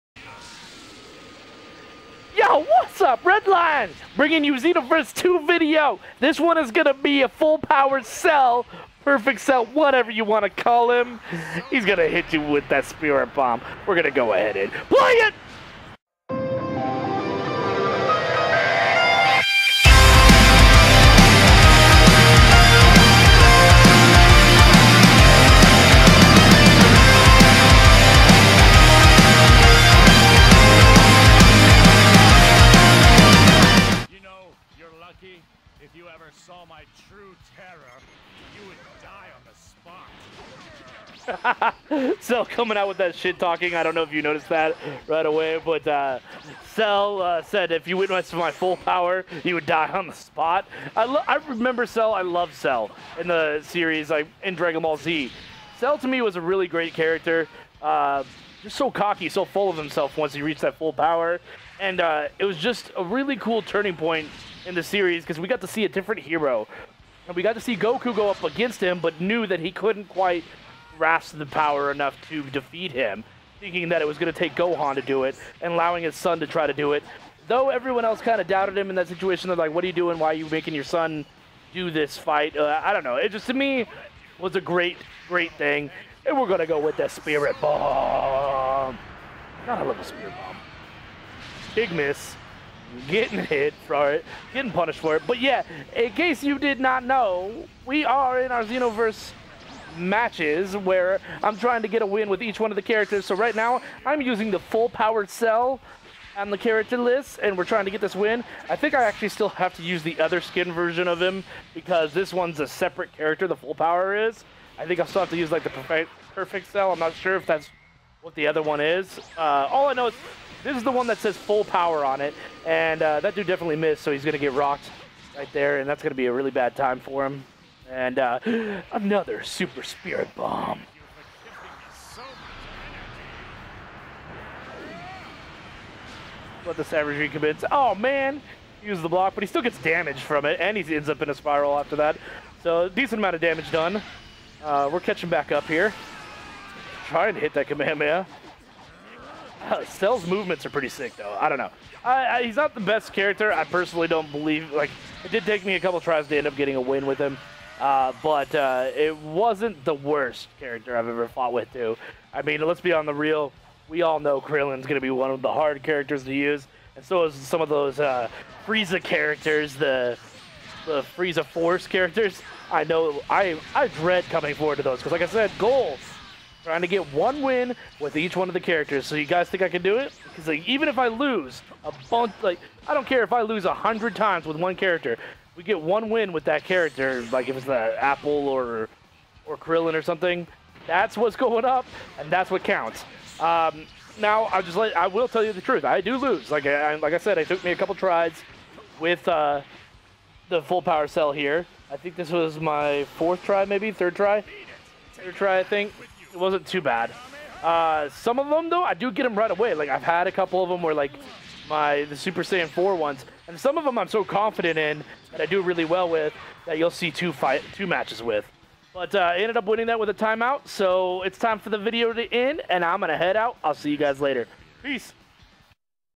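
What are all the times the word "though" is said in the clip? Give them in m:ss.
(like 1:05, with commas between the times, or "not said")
1:17, 2:31, 3:28.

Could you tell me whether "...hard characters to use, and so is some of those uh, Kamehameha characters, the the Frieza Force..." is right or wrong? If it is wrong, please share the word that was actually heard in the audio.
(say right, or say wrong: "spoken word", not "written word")
wrong: "Frieza", not "Kamehameha".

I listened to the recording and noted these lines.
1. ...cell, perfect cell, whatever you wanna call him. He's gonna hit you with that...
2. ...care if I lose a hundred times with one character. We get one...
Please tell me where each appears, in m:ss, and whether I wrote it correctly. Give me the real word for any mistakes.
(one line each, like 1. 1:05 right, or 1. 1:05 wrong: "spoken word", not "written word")
1. 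0:08 right
2. 3:03 right.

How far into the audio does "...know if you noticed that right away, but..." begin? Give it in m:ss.
0:43.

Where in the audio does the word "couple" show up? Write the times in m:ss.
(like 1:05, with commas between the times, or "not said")
2:35, 3:17, 3:30.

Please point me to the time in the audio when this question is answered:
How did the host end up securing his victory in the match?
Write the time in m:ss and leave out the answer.
3:40.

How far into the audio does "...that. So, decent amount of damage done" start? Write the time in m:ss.
2:21.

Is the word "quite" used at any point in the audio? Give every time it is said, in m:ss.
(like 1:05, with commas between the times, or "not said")
1:10.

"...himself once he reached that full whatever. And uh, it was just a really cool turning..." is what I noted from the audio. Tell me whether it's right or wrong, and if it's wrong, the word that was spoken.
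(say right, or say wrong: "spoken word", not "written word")
wrong: "power", not "whatever".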